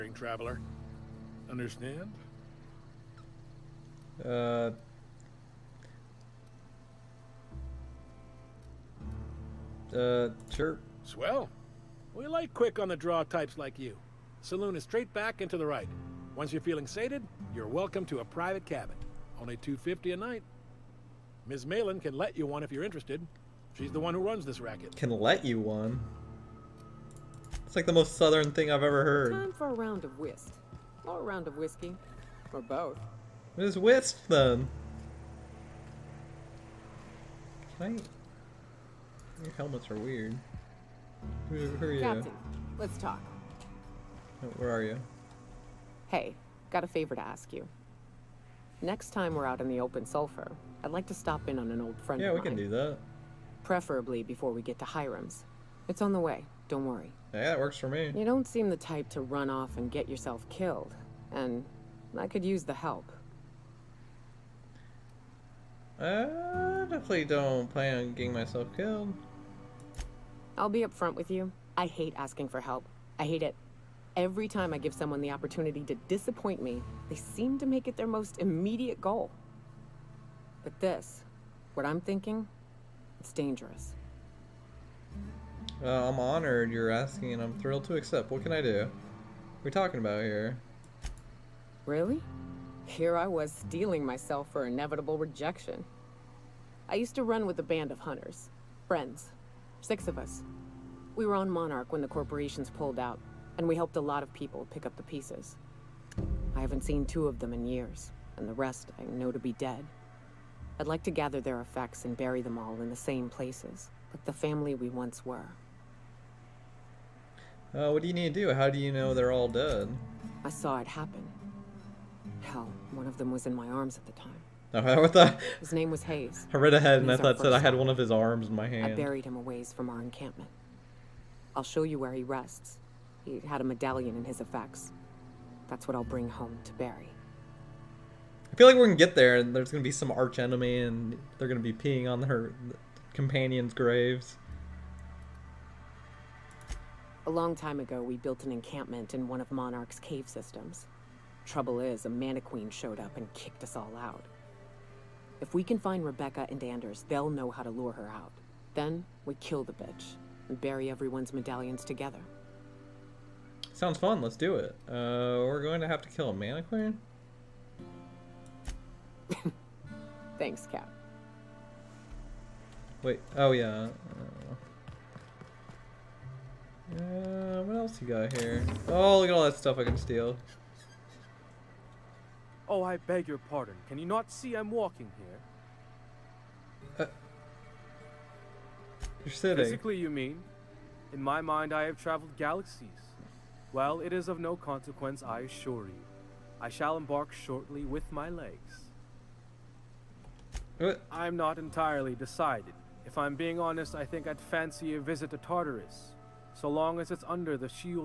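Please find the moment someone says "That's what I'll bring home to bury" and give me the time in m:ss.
2:15.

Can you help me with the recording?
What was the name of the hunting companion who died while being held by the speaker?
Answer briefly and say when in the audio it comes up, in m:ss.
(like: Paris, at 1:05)
Hayes, at 2:06.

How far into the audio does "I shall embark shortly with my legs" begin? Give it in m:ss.
3:16.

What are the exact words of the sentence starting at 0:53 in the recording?
Preferably before we get to Hiram's.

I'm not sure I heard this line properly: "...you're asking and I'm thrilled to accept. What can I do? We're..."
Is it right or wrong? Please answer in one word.
right.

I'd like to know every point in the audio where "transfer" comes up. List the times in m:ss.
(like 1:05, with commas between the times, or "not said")
not said.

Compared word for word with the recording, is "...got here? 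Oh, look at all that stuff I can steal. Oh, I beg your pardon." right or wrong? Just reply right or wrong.
right.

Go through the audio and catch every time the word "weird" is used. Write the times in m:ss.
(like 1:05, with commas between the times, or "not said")
0:40.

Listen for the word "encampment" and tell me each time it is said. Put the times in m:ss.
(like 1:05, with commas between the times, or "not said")
2:10, 2:28.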